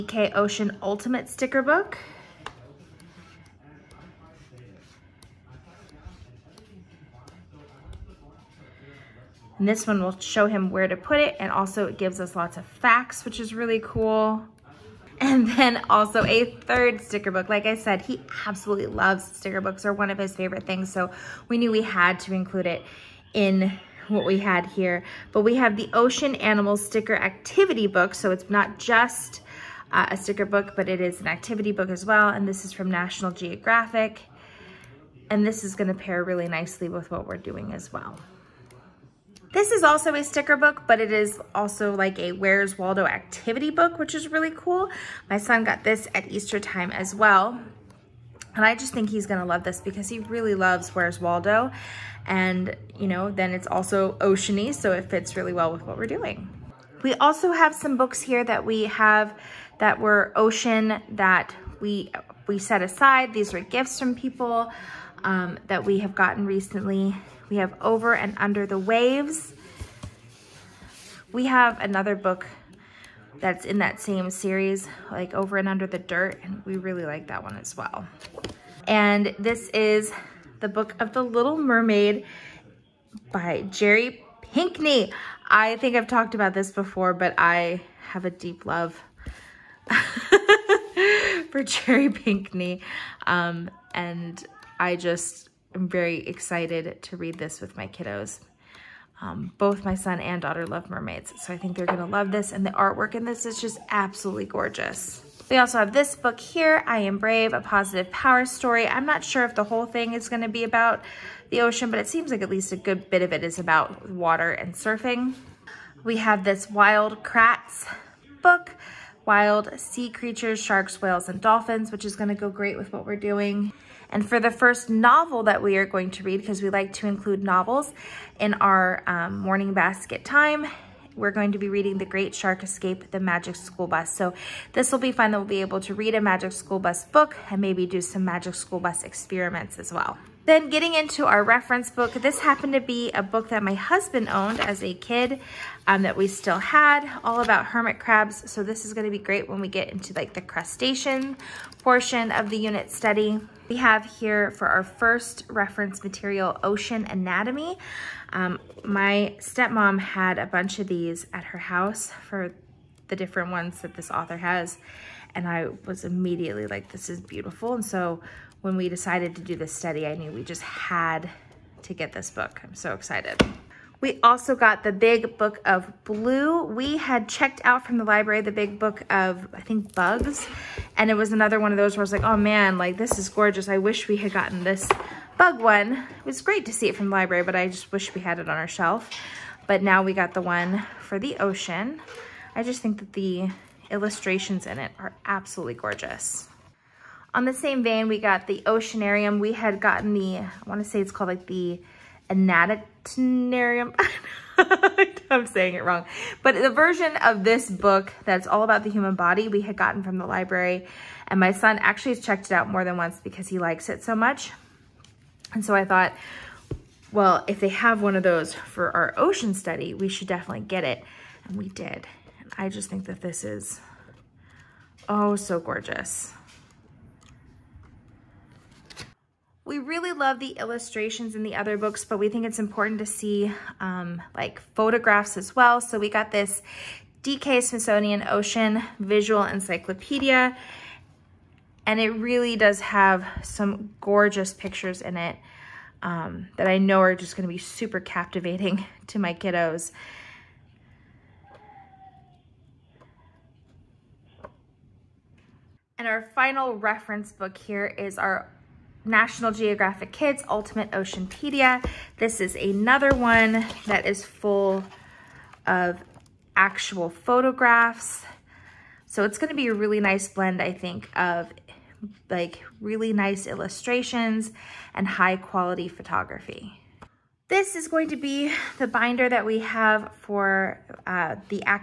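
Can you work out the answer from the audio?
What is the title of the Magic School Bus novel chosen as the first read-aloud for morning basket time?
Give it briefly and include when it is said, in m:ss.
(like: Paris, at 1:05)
The Great Shark Escape, at 2:11.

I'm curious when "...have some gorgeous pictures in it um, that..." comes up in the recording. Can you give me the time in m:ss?
4:02.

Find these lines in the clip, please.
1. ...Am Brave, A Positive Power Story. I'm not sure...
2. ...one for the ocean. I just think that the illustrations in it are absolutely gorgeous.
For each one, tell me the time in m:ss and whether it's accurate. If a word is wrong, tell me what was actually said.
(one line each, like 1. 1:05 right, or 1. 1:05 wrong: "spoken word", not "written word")
1. 1:46 right
2. 3:10 right.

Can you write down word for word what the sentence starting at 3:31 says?
And my son actually has checked it out more than once because he likes it so much.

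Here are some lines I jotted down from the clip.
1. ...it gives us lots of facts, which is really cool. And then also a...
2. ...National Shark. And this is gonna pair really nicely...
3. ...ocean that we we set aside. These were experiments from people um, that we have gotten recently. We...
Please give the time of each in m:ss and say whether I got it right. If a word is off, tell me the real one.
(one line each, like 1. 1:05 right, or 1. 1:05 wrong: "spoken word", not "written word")
1. 0:11 right
2. 0:32 wrong: "Geographic", not "Shark"
3. 1:00 wrong: "gifts", not "experiments".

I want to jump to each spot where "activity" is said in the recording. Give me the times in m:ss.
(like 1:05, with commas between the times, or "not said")
0:27, 0:31, 0:43.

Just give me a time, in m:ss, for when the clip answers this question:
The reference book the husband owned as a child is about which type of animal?
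2:27.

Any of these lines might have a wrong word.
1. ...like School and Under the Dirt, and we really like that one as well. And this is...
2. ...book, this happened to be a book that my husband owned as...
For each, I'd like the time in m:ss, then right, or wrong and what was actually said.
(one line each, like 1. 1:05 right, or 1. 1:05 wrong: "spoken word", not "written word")
1. 1:15 wrong: "Over", not "School"
2. 2:21 right.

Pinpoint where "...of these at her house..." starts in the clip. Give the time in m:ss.
2:40.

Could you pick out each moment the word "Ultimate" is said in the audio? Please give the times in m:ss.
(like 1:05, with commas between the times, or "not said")
0:00, 4:20.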